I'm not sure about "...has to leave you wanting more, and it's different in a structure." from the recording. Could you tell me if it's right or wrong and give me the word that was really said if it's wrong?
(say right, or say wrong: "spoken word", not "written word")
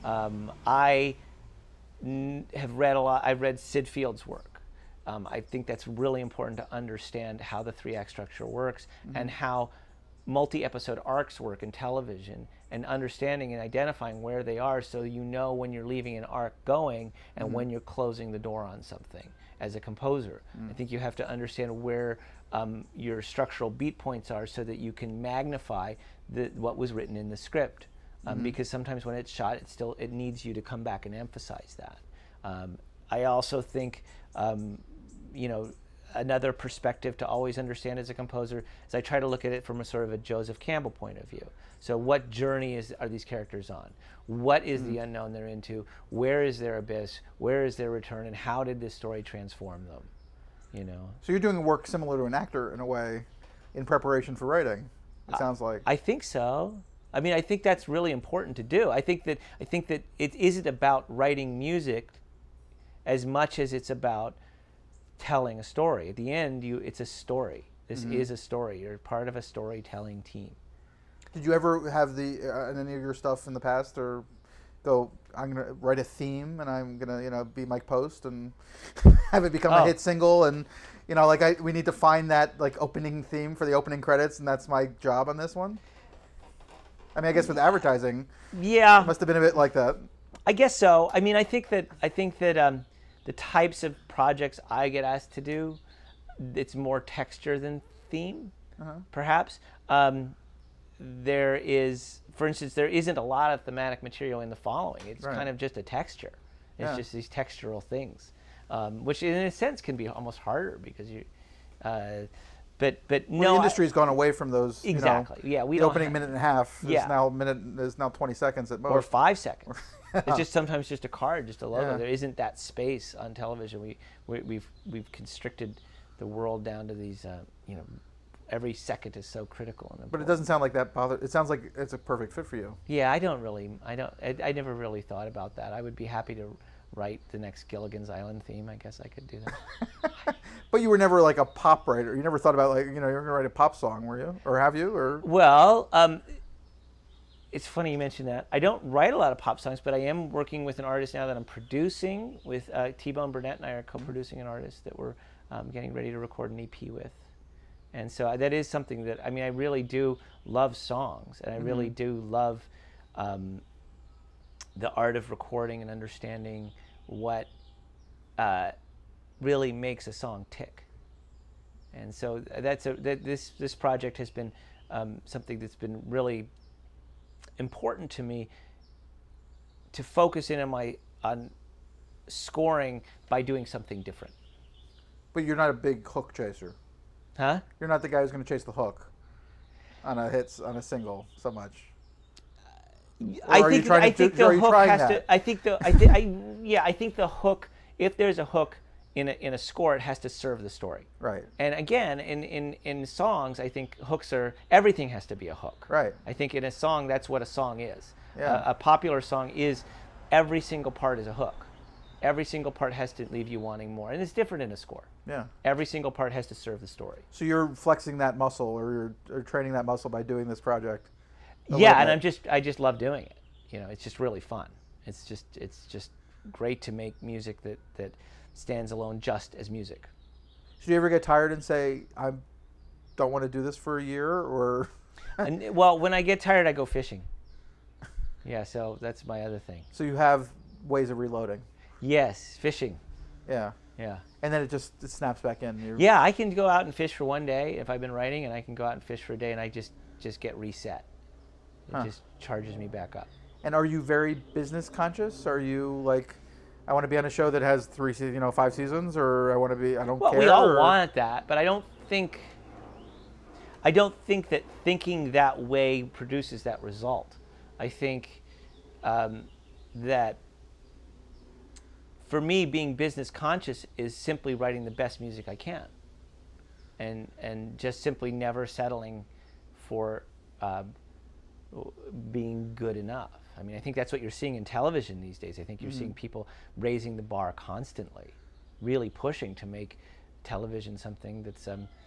wrong: "score", not "structure".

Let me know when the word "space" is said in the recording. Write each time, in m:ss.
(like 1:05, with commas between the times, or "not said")
2:02.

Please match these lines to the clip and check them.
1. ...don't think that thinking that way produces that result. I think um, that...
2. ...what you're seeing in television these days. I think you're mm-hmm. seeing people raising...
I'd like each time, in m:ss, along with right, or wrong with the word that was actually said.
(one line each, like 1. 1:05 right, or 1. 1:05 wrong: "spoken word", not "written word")
1. 4:23 right
2. 4:44 right.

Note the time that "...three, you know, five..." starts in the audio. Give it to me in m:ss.
4:17.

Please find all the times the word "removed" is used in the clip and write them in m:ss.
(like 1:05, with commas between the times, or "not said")
not said.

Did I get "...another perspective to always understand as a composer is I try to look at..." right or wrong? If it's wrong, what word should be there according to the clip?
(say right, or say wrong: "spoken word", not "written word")
right.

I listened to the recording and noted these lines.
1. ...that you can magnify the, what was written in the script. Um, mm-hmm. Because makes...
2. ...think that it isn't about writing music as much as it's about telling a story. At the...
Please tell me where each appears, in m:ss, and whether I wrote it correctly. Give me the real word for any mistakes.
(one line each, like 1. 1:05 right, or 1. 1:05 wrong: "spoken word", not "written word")
1. 0:24 wrong: "sometimes", not "makes"
2. 0:59 right.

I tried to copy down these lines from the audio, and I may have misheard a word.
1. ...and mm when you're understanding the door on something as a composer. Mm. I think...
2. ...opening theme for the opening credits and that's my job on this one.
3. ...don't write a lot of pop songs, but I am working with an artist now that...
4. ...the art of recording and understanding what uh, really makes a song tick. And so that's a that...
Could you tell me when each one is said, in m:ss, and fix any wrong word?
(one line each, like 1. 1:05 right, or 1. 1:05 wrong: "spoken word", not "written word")
1. 0:17 wrong: "closing", not "understanding"
2. 1:22 right
3. 2:28 right
4. 2:44 right.